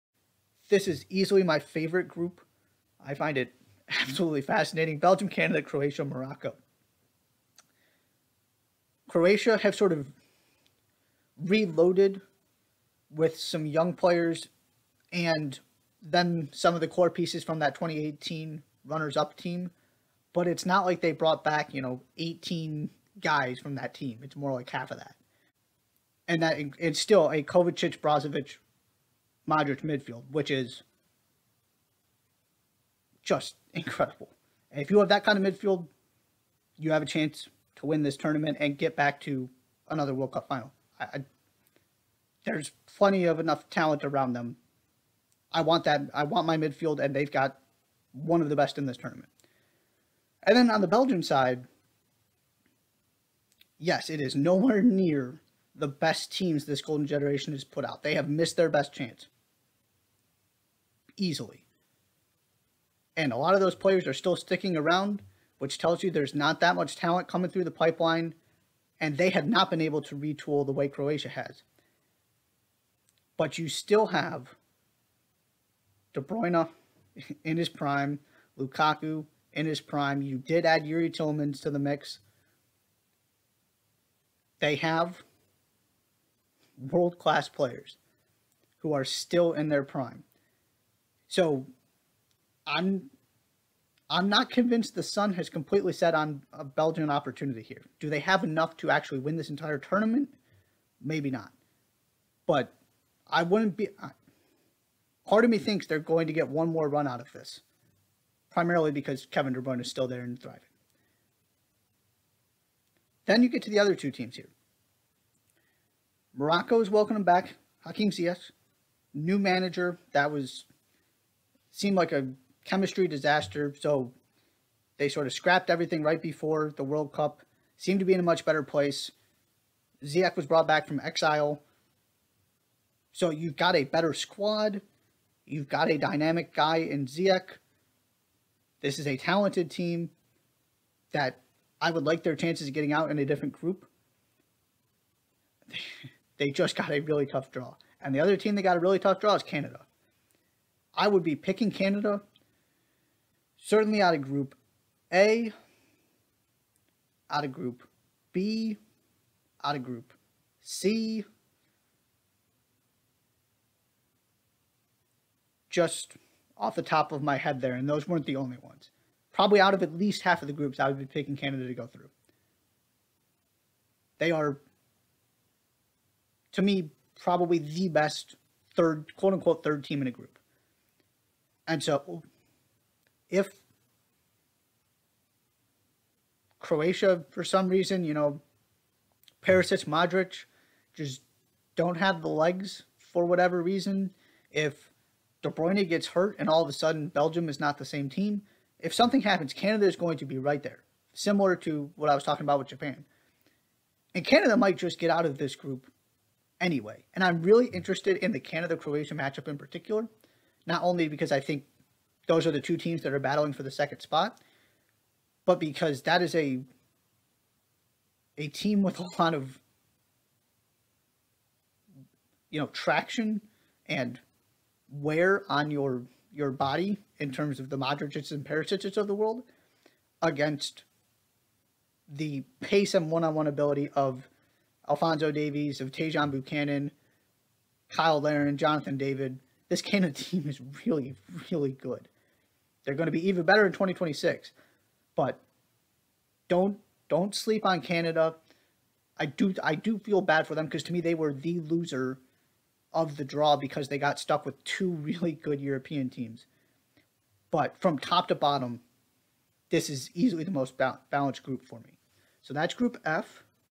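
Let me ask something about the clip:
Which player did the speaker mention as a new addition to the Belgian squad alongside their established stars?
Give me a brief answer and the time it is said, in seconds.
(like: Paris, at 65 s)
Youri Tielemans, at 80 s.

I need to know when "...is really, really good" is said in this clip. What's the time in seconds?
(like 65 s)
240 s.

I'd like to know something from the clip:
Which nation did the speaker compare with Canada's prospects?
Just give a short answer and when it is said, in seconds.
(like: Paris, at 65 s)
Japan, at 202 s.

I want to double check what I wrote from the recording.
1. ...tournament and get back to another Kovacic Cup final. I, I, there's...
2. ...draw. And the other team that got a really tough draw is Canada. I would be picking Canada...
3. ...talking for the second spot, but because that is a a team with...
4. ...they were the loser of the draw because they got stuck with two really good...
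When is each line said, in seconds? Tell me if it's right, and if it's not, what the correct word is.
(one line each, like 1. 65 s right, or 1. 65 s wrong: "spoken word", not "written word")
1. 38 s wrong: "World", not "Kovacic"
2. 147 s right
3. 213 s wrong: "battling", not "talking"
4. 251 s right.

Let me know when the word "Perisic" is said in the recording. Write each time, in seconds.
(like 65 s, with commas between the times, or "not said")
189 s, 228 s.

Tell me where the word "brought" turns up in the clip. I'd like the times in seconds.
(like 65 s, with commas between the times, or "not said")
21 s, 130 s.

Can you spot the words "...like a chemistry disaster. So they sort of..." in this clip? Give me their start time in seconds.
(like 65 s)
121 s.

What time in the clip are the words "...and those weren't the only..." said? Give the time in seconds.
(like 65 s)
167 s.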